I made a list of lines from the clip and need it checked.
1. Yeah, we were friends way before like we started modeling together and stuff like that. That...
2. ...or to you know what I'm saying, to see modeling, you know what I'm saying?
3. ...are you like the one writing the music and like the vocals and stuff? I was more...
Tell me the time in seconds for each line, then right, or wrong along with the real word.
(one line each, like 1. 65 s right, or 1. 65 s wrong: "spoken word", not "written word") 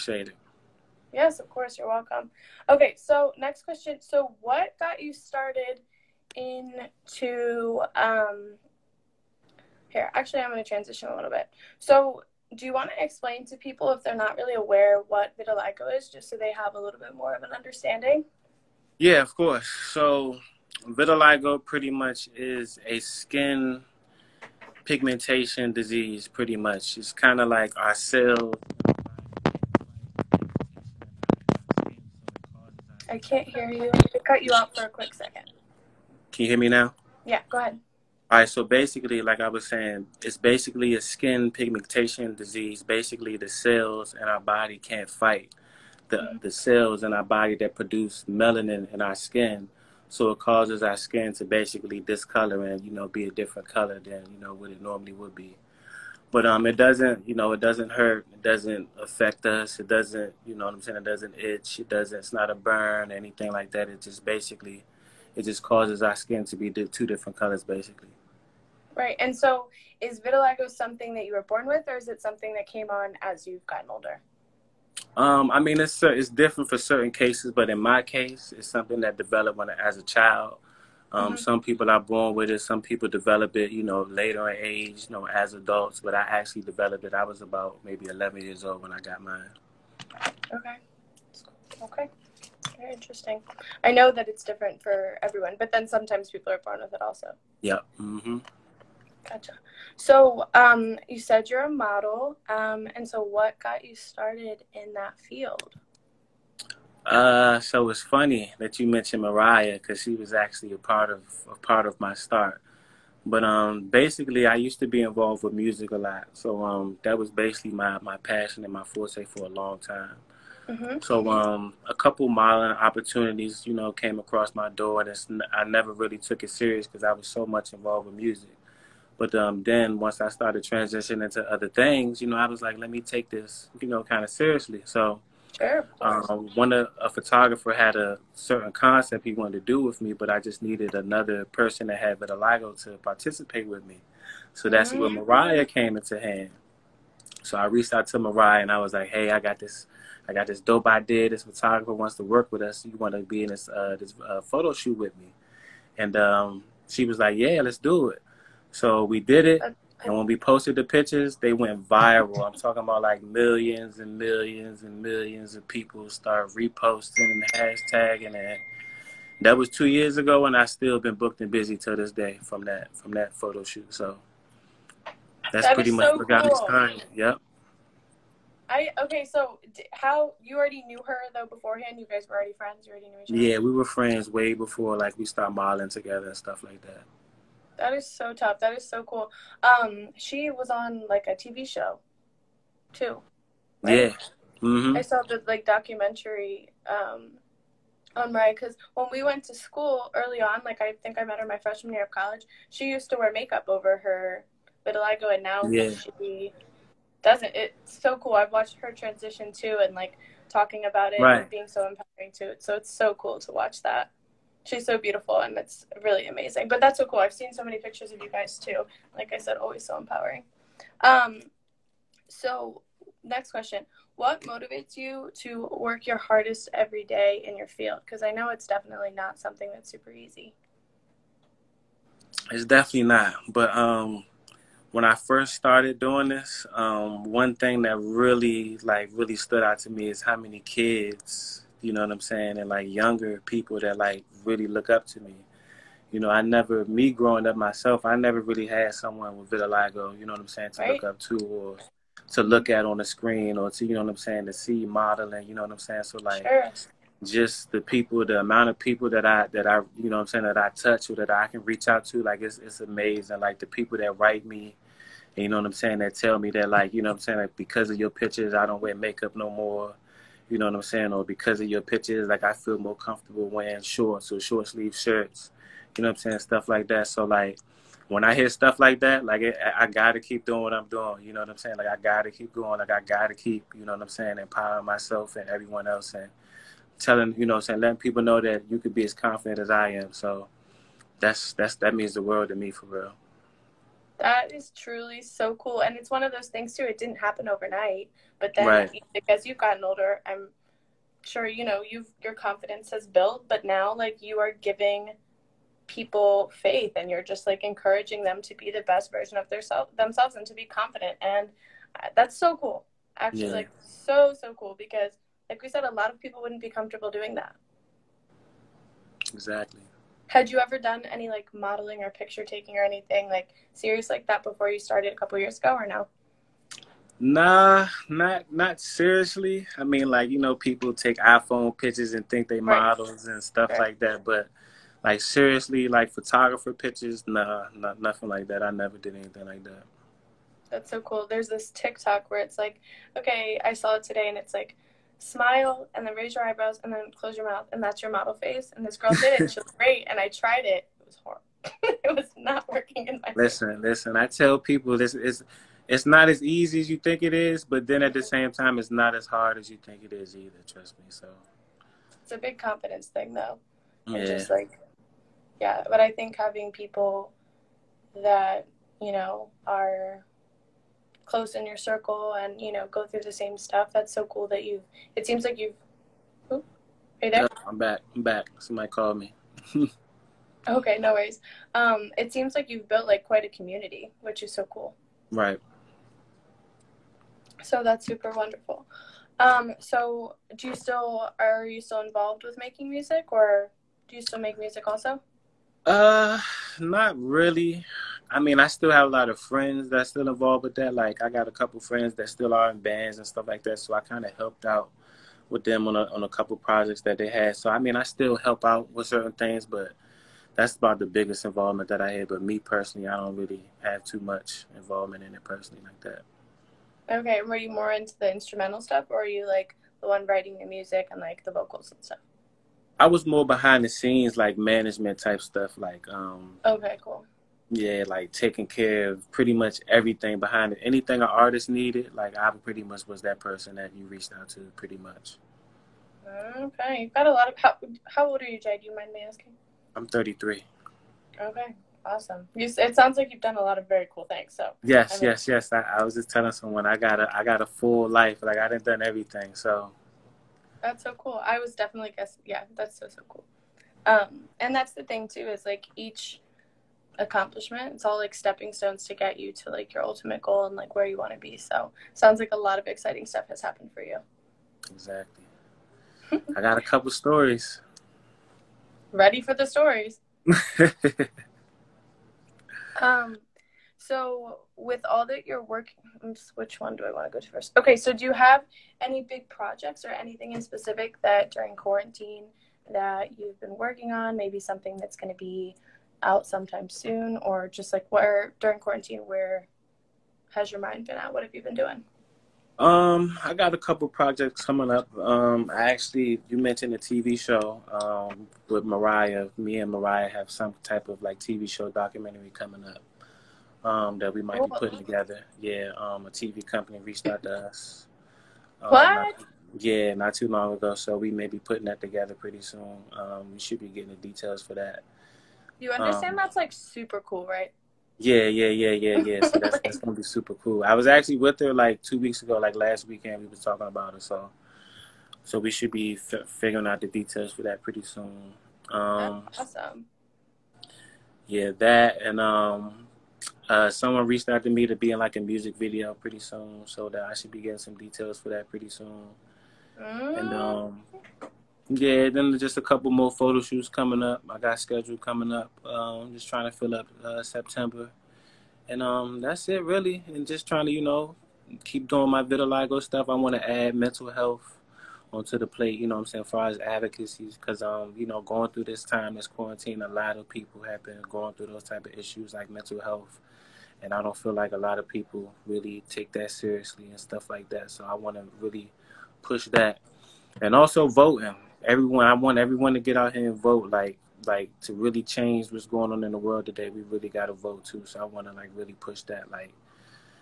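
1. 183 s right
2. 253 s right
3. 419 s right.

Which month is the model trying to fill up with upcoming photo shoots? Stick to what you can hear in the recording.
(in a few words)
September.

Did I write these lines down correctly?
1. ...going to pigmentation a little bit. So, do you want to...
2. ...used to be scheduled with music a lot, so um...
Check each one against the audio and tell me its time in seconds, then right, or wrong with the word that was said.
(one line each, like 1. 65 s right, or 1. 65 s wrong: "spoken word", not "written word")
1. 10 s wrong: "transition", not "pigmentation"
2. 114 s wrong: "involved", not "scheduled".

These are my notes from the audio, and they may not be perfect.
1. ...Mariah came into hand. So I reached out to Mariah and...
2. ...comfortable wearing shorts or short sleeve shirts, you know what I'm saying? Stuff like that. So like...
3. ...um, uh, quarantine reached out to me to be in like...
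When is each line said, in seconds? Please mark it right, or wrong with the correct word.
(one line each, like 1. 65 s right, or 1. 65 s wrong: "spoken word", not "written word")
1. 145 s right
2. 272 s right
3. 532 s wrong: "someone", not "quarantine".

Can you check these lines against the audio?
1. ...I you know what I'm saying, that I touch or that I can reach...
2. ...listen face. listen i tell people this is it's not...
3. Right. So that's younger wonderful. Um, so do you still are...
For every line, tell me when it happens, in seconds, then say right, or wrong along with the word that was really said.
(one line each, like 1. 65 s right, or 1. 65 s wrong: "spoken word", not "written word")
1. 259 s right
2. 353 s right
3. 385 s wrong: "super", not "younger".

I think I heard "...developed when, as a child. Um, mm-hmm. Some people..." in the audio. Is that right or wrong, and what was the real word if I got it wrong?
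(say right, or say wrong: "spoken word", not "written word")
right.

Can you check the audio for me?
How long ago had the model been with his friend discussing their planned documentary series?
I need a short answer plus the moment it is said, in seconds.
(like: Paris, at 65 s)
two weeks ago, at 522 s.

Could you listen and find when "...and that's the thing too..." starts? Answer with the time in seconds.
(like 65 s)
454 s.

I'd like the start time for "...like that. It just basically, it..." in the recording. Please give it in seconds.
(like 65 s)
63 s.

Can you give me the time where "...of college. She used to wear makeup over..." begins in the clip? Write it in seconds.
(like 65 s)
202 s.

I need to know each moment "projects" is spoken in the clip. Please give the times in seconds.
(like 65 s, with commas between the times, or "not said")
406 s, 479 s, 494 s.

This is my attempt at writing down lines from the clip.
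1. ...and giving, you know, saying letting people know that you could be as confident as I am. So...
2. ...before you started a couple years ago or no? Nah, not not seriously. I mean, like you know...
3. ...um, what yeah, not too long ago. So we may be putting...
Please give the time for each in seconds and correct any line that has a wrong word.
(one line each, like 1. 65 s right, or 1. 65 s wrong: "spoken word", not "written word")
1. 286 s wrong: "telling", not "giving"
2. 324 s right
3. 508 s right.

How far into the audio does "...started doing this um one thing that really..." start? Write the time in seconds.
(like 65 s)
235 s.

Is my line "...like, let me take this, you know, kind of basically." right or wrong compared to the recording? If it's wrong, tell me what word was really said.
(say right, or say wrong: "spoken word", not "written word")
wrong: "seriously", not "basically".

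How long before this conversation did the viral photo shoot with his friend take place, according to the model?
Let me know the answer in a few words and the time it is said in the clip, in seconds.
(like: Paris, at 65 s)
two years ago, at 169 s.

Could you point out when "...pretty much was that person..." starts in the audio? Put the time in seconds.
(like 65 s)
432 s.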